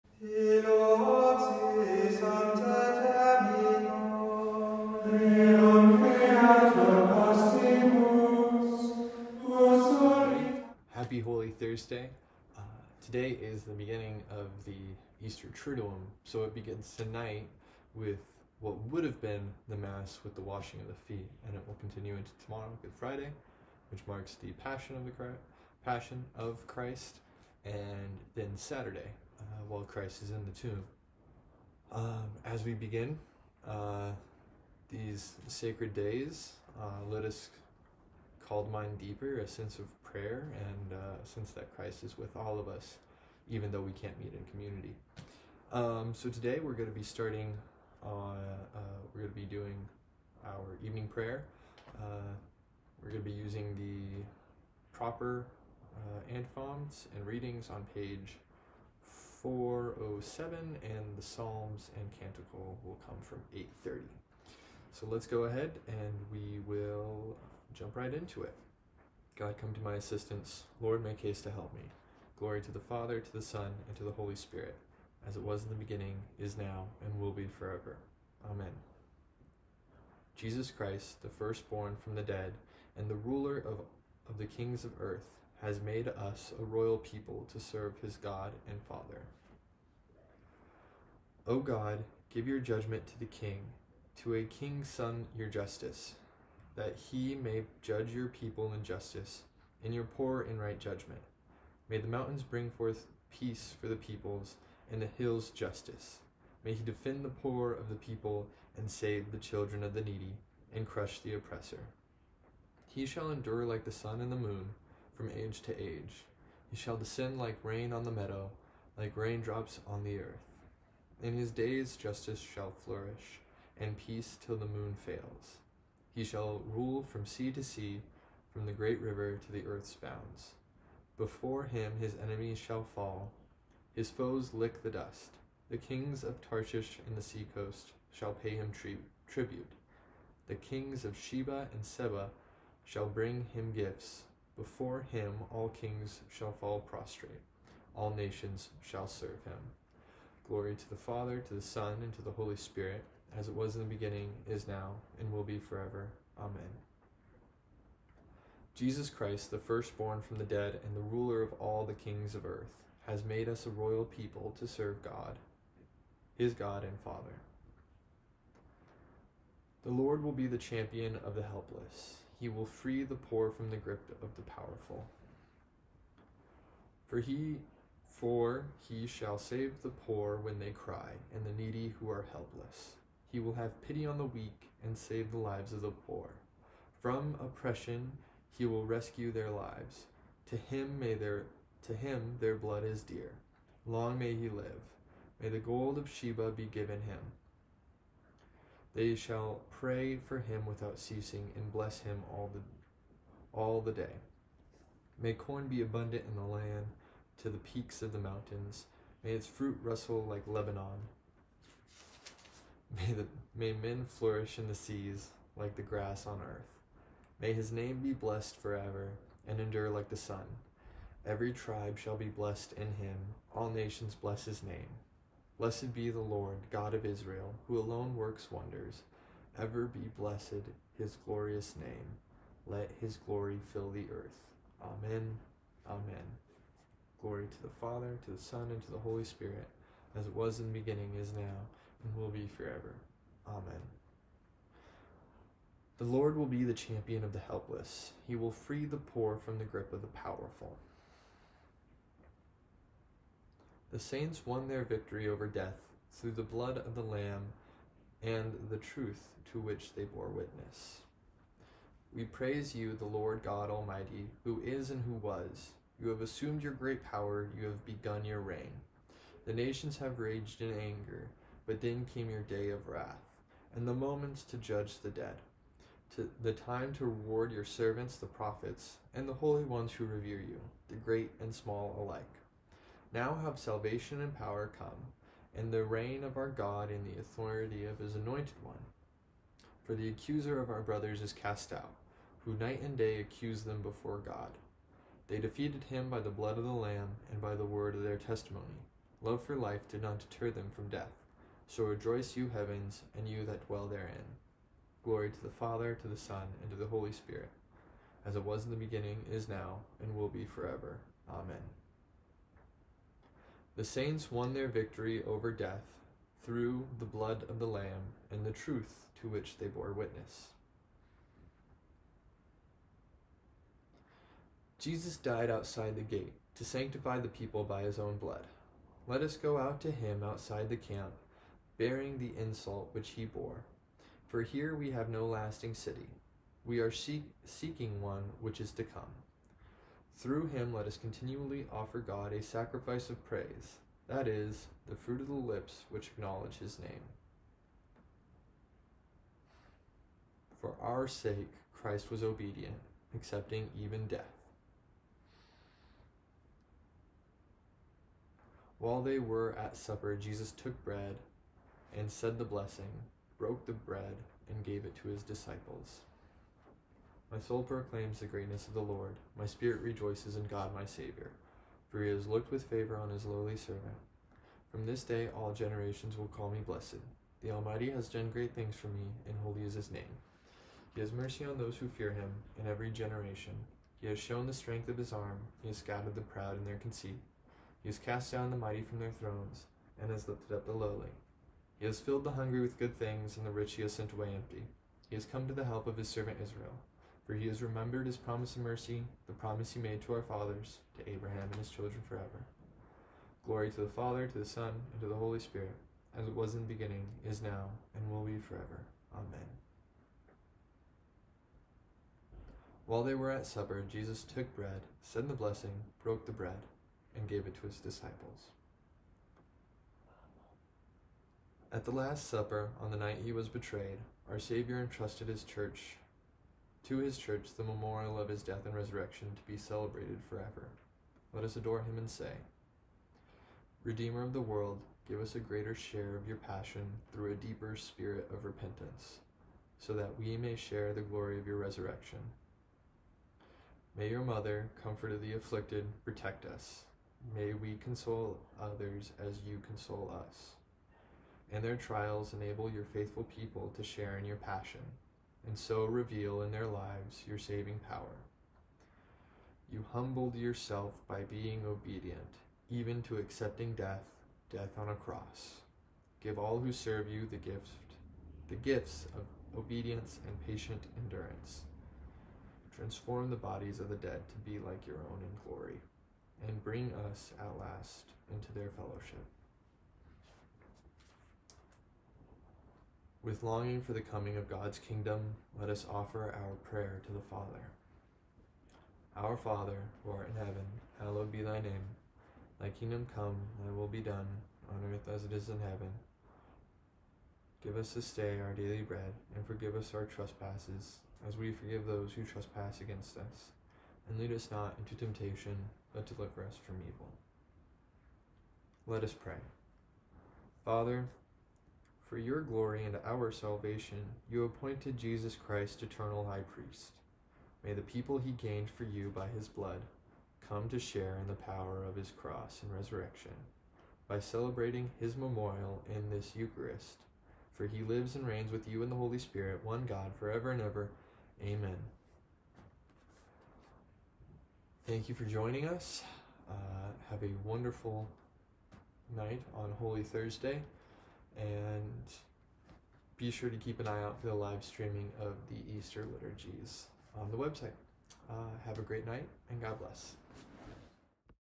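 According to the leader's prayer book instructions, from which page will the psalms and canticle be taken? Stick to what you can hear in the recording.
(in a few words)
830.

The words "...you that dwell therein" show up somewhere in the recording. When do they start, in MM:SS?
05:03.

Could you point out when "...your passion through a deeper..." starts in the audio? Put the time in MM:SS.
07:16.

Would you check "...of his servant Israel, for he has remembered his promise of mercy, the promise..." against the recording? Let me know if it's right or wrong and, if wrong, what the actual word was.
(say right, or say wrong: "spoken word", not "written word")
right.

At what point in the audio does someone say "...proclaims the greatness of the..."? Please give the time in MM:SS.
06:07.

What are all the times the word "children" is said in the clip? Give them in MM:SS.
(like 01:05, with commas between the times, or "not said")
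01:49, 06:41.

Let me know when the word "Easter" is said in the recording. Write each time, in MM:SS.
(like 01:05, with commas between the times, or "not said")
00:15, 09:05.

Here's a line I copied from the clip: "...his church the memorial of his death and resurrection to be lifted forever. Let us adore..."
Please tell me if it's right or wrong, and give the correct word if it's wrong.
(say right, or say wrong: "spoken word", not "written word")
wrong: "celebrated", not "lifted".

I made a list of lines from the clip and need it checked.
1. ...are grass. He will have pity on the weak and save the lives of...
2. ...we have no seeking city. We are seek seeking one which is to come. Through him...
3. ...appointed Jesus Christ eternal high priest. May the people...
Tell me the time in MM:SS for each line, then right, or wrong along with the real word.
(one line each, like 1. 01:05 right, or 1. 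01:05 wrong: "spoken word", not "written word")
1. 03:02 wrong: "helpless", not "grass"
2. 05:34 wrong: "lasting", not "seeking"
3. 08:34 right.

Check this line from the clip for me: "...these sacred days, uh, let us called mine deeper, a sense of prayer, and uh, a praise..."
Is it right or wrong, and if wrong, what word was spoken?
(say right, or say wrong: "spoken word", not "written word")
wrong: "sense", not "praise".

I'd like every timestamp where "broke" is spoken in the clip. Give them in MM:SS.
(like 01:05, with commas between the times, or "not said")
06:03, 06:56.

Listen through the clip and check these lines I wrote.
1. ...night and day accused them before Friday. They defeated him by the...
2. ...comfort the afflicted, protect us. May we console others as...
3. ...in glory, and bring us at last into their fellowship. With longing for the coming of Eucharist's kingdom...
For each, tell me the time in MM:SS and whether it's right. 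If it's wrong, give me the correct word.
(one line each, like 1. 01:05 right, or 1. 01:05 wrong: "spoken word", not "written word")
1. 04:52 wrong: "God", not "Friday"
2. 07:24 right
3. 07:55 wrong: "God", not "Eucharist".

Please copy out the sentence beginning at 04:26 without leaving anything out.
You have assumed your great power, you have begun your reign.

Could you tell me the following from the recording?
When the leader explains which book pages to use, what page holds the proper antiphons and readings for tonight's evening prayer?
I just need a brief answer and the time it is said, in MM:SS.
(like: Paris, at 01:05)
407, at 00:57.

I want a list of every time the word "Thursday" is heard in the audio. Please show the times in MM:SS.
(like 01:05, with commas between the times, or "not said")
09:00.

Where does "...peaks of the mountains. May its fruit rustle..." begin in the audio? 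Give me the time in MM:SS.
03:27.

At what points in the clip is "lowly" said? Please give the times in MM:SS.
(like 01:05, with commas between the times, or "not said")
06:13, 06:30.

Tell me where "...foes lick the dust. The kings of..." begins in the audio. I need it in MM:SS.
02:14.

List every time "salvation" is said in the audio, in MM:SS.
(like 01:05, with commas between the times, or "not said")
04:43, 08:33.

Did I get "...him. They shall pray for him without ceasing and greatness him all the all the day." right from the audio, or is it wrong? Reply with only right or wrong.
wrong.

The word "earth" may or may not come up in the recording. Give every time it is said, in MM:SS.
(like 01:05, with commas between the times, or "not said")
01:24, 02:00, 02:09, 02:42, 03:36, 03:54, 08:14.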